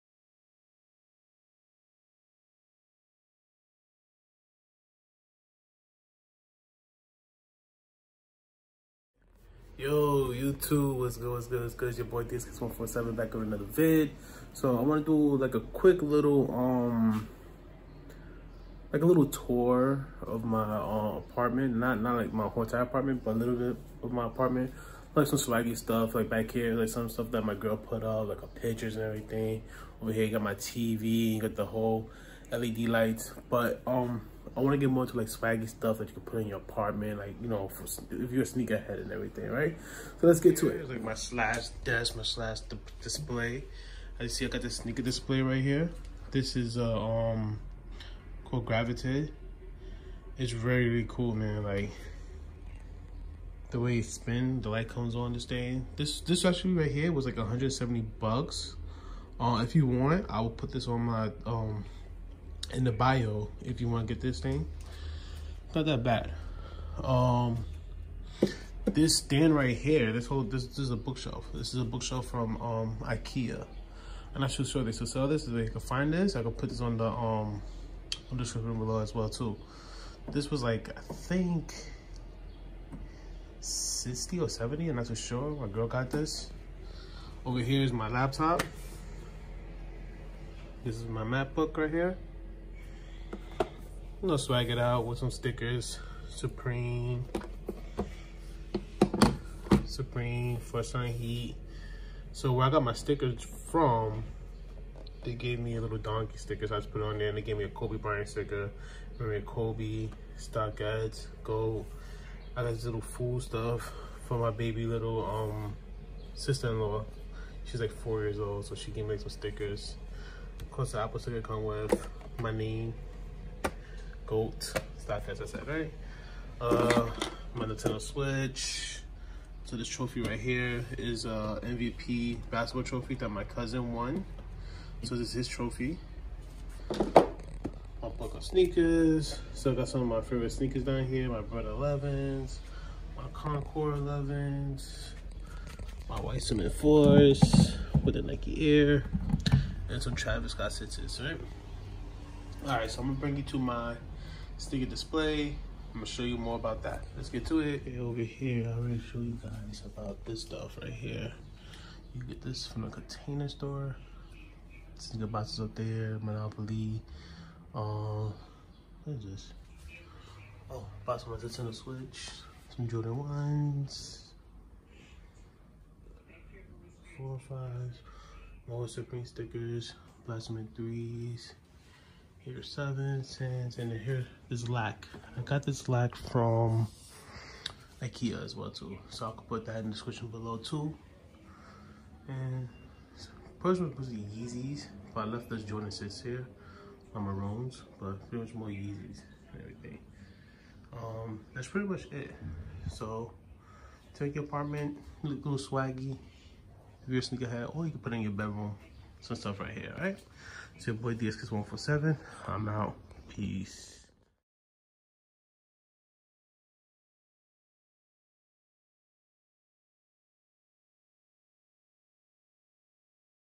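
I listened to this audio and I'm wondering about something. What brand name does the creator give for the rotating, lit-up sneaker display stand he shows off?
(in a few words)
Grvtate.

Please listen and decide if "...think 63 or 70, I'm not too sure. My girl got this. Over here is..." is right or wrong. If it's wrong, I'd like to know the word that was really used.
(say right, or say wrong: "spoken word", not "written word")
wrong: "60", not "63".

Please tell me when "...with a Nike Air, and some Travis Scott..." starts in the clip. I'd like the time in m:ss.
2:28.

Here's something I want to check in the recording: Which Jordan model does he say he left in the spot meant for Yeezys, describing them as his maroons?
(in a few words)
Jordan 6.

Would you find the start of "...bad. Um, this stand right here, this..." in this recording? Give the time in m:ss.
1:06.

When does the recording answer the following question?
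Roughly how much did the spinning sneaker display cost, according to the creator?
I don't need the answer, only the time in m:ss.
0:57.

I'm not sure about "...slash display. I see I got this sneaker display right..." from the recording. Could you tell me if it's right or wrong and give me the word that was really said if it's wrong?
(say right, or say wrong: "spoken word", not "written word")
right.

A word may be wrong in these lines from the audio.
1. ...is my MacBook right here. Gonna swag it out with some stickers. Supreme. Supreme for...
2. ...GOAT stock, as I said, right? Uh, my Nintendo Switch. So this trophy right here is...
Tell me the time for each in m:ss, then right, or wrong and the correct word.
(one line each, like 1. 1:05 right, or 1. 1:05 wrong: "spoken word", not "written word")
1. 1:30 right
2. 2:04 right.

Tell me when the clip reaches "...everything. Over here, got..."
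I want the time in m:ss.
0:29.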